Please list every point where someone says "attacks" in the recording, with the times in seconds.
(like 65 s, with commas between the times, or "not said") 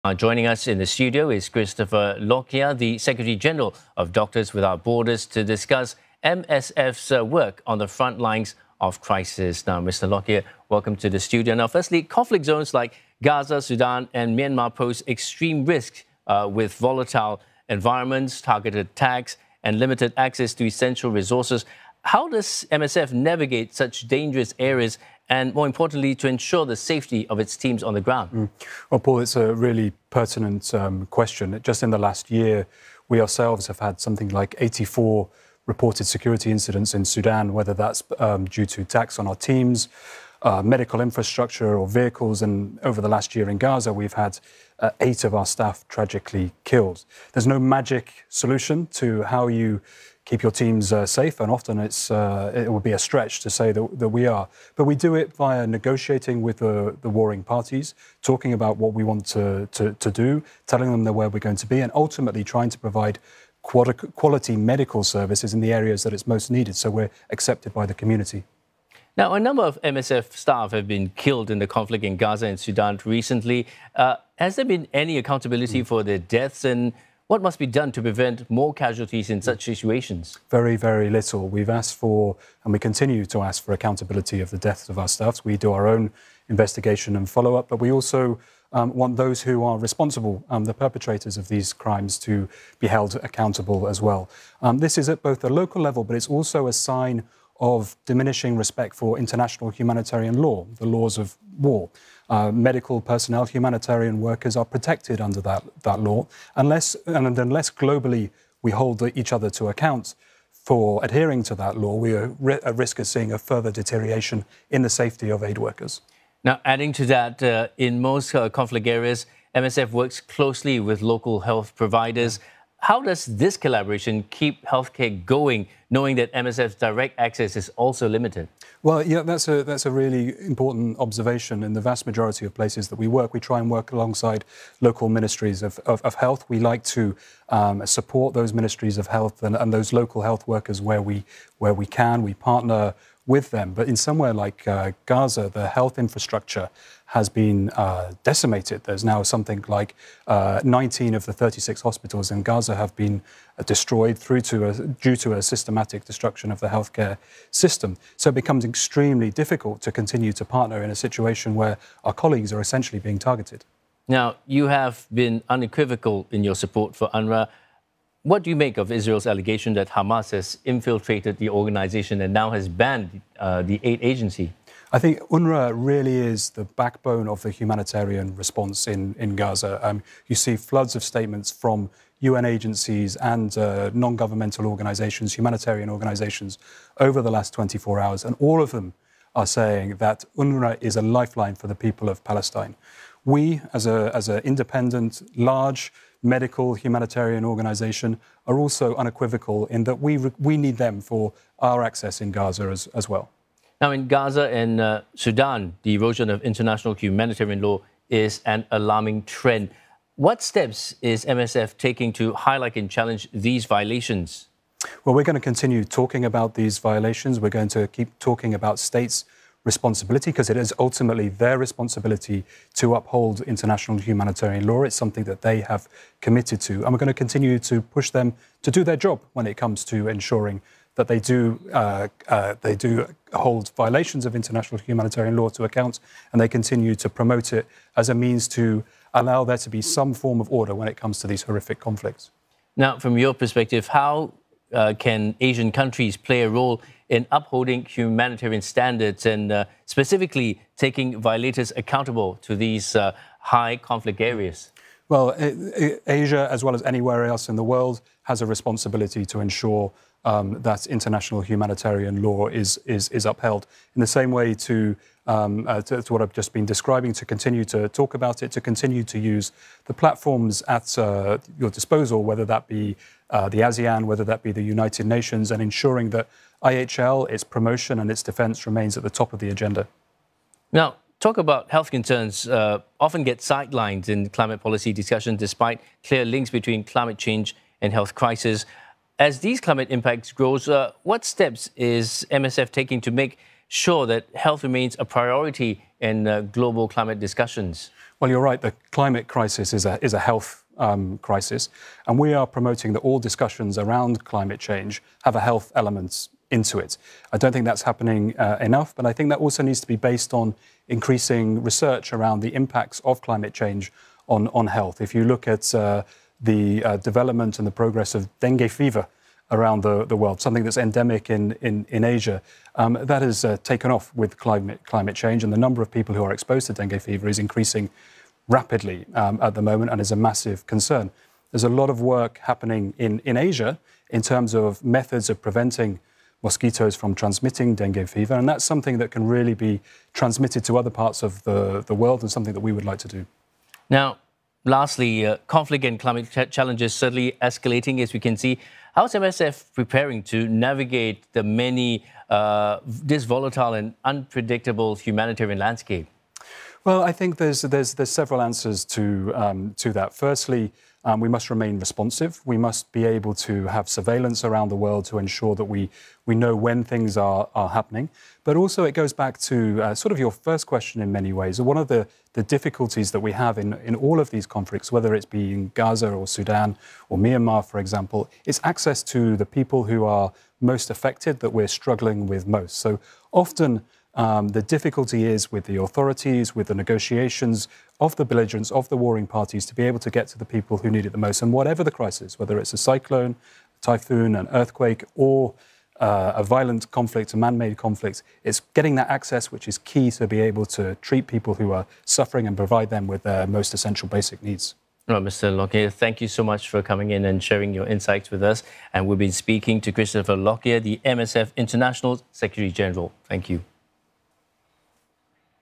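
18 s, 38 s.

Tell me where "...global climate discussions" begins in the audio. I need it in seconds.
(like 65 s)
296 s.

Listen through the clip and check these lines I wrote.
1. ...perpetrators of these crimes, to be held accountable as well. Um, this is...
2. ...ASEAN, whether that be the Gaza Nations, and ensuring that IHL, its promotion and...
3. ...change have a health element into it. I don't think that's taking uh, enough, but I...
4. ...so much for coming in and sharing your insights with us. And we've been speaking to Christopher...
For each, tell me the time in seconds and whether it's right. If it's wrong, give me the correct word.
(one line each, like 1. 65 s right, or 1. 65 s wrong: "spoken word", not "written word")
1. 90 s right
2. 273 s wrong: "United", not "Gaza"
3. 304 s wrong: "happening", not "taking"
4. 406 s right.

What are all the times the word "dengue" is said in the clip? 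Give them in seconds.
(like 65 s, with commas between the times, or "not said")
318 s, 326 s, 337 s.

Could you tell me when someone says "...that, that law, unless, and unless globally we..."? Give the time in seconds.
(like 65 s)
105 s.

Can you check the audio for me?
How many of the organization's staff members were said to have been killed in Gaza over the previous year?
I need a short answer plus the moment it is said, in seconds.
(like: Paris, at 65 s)
8, at 44 s.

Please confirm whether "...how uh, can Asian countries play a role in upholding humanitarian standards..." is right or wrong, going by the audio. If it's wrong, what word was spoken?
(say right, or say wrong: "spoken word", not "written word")
right.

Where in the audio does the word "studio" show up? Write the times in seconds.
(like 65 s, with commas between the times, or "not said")
0 s, 11 s.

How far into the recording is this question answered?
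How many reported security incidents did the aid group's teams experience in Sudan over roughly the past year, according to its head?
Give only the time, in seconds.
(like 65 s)
34 s.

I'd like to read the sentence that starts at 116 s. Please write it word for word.
Now, adding to that, uh, in most uh, conflict areas, MSF works closely with local health providers.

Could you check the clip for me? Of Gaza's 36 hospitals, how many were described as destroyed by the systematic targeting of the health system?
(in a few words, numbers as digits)
19.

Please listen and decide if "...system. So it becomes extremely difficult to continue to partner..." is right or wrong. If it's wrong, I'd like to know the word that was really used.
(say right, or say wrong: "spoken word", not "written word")
right.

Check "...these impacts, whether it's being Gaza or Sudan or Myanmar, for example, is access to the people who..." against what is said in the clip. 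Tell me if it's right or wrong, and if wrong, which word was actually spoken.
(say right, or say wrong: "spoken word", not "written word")
wrong: "conflicts", not "impacts".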